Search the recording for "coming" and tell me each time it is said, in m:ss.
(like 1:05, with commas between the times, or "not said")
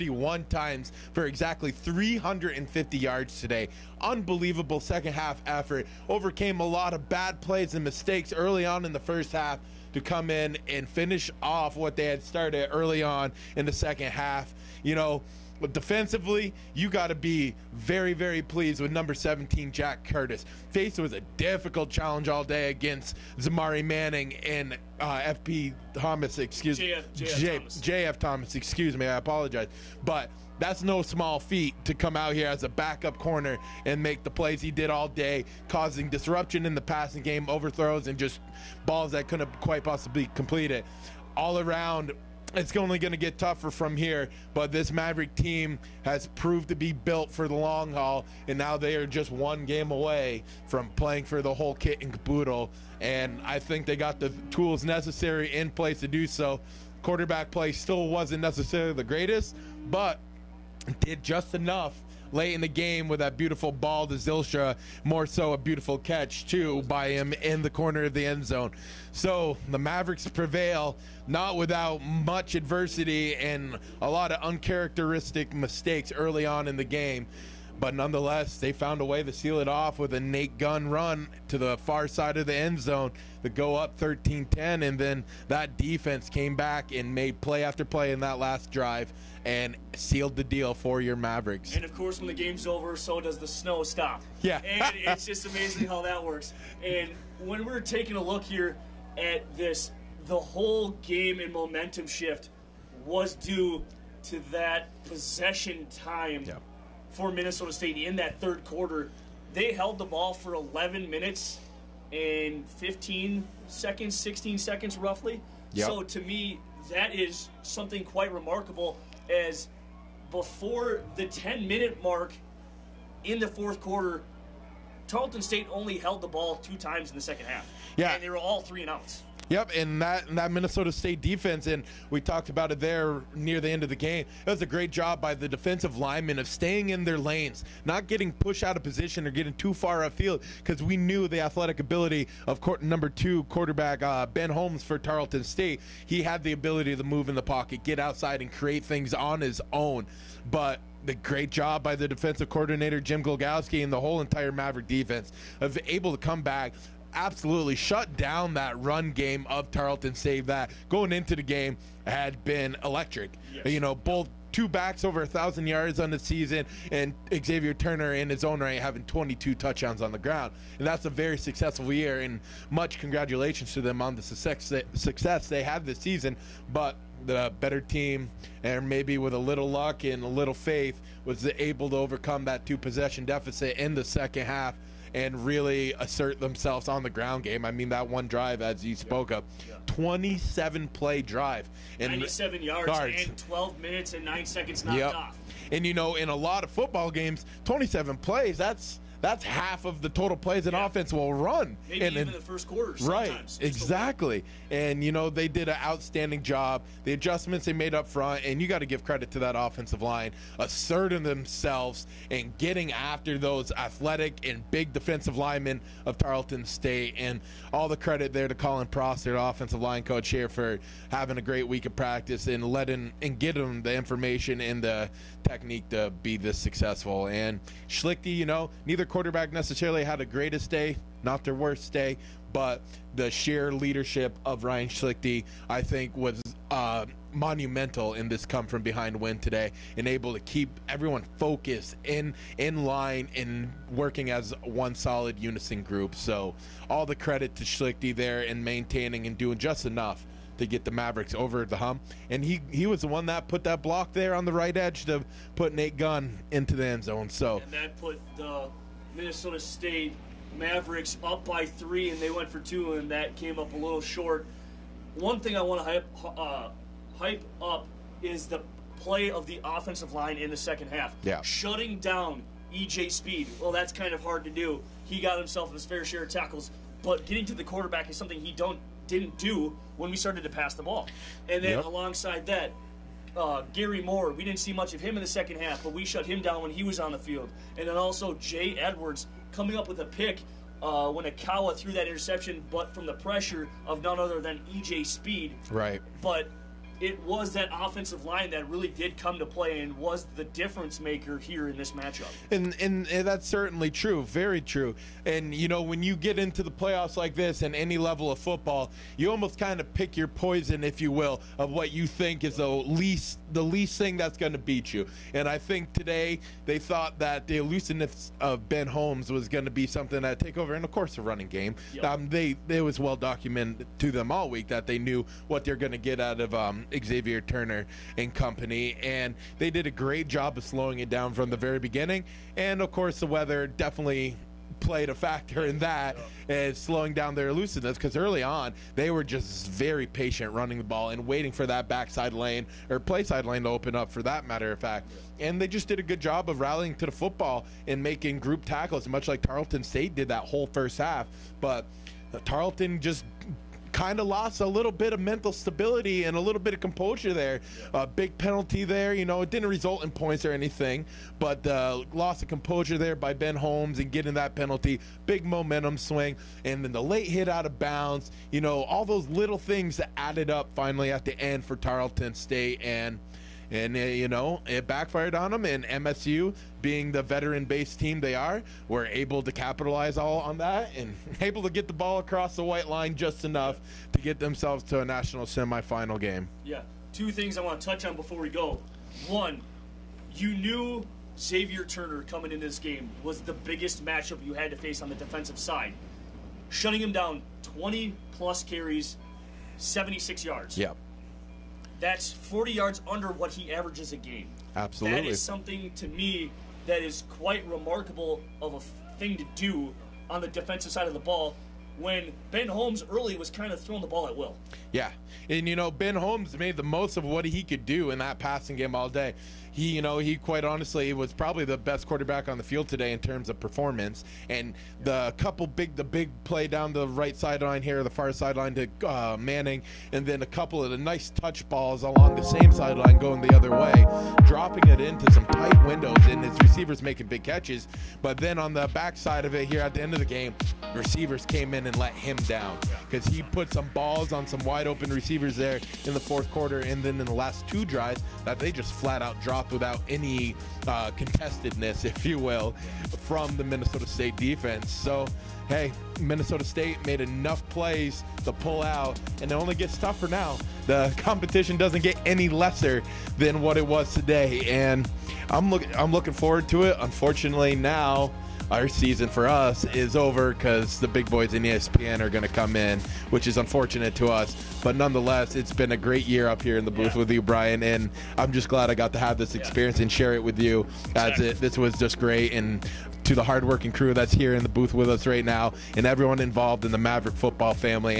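4:49, 6:32.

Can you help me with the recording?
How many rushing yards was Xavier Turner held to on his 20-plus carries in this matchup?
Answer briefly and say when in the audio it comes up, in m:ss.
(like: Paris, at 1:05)
76, at 6:39.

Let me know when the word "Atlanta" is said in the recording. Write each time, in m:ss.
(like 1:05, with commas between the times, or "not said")
not said.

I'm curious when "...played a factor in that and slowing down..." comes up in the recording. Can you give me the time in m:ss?
5:34.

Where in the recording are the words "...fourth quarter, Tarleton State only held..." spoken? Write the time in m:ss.
2:03.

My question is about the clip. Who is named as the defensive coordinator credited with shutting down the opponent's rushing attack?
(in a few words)
Jim Glogowski.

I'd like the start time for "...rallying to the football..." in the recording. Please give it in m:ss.
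5:46.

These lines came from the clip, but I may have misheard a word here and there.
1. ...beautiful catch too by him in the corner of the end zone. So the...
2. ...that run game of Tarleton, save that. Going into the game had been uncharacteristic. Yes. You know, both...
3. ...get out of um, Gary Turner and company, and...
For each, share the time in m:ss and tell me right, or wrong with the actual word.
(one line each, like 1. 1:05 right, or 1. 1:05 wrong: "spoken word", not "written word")
1. 1:05 right
2. 2:38 wrong: "electric", not "uncharacteristic"
3. 5:25 wrong: "Xavier", not "Gary".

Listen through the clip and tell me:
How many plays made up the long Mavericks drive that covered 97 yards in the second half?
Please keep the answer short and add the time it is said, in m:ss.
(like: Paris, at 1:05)
27, at 3:09.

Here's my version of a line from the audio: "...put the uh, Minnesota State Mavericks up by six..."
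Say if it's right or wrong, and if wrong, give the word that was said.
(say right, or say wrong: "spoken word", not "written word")
wrong: "three", not "six".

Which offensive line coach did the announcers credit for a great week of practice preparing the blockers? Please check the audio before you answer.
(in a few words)
Colin Prosser.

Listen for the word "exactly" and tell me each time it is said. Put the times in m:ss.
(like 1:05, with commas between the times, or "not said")
0:01, 3:23.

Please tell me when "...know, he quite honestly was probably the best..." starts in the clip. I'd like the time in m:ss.
7:00.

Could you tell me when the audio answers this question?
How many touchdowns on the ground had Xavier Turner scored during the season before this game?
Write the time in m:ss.
2:49.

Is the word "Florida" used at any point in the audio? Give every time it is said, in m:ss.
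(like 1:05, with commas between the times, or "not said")
not said.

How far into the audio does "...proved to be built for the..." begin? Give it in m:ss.
0:46.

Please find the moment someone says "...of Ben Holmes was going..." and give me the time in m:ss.
5:18.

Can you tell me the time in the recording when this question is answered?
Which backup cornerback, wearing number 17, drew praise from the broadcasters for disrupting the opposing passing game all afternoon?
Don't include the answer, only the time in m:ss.
0:19.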